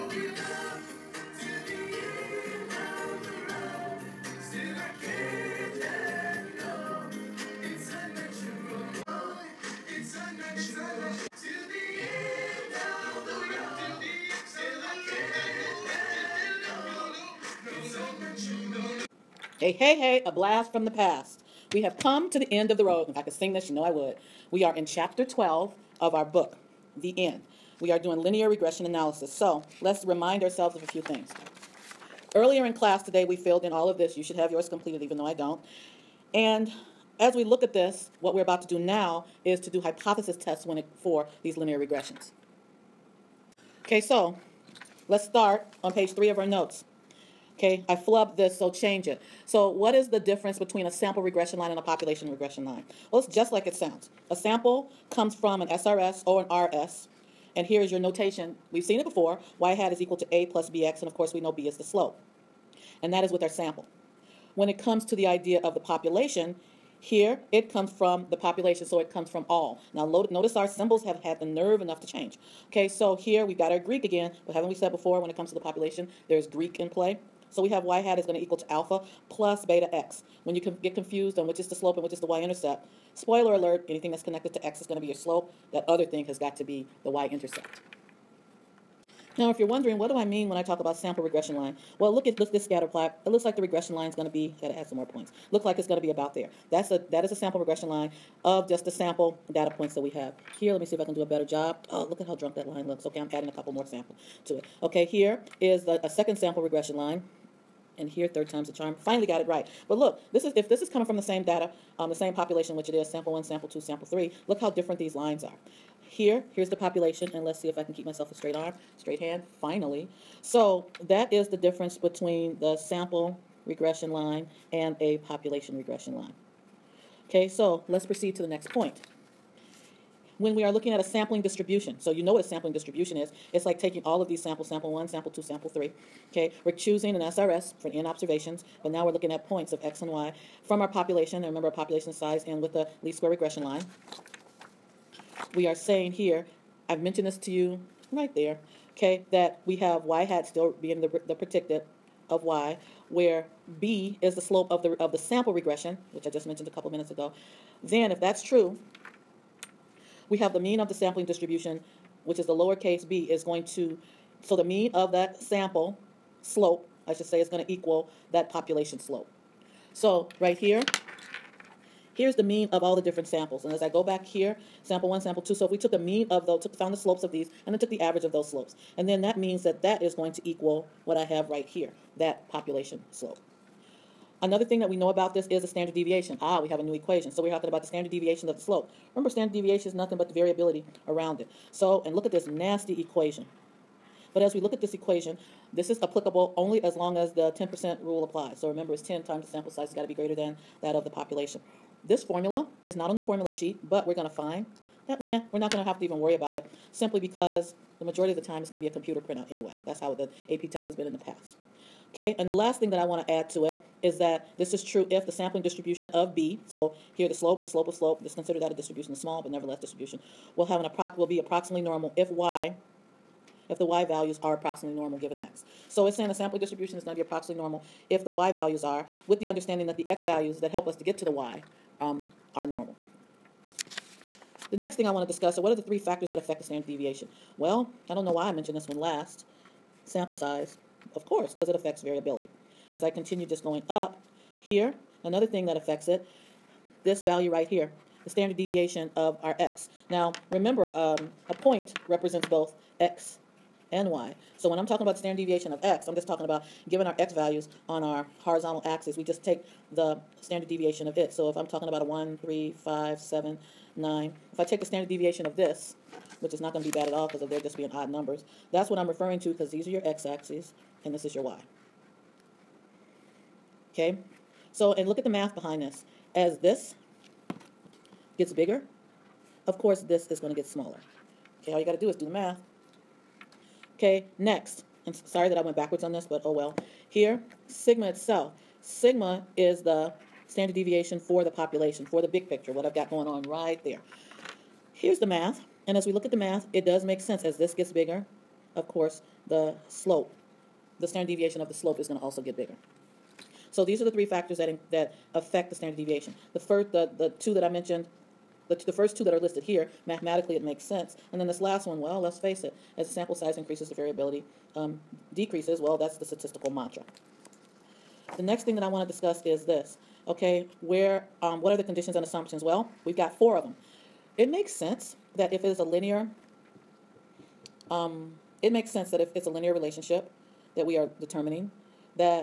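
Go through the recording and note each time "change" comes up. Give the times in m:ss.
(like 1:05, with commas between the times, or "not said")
0:48, 1:12.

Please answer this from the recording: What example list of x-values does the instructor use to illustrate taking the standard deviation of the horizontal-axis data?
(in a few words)
1, 3, 5, 7, 9.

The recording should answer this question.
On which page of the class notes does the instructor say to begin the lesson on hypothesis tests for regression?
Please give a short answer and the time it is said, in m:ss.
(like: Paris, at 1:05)
3, at 0:45.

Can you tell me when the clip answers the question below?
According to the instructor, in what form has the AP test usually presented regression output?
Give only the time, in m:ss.
3:28.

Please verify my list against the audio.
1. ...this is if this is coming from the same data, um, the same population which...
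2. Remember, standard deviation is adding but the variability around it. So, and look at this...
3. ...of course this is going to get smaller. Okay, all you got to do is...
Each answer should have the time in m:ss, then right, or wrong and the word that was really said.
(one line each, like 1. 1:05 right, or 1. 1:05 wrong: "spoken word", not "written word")
1. 1:50 right
2. 3:09 wrong: "nothing", not "adding"
3. 4:39 right.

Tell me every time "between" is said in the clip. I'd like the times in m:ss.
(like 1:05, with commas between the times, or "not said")
0:50, 2:01.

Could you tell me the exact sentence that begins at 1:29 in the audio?
Now, if you're wondering, what do I mean when I talk about sample regression line?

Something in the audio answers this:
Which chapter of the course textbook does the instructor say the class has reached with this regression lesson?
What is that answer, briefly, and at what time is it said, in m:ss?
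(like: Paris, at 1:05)
12, at 0:24.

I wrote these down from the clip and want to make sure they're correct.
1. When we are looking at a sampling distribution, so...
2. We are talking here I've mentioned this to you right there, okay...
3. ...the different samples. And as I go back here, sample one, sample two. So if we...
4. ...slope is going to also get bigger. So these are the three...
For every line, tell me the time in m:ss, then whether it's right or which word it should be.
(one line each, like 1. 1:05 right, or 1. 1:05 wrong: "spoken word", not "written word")
1. 2:10 right
2. 2:25 wrong: "saying", not "talking"
3. 2:52 right
4. 5:01 right.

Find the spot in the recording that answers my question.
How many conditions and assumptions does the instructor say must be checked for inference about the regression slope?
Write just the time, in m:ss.
5:23.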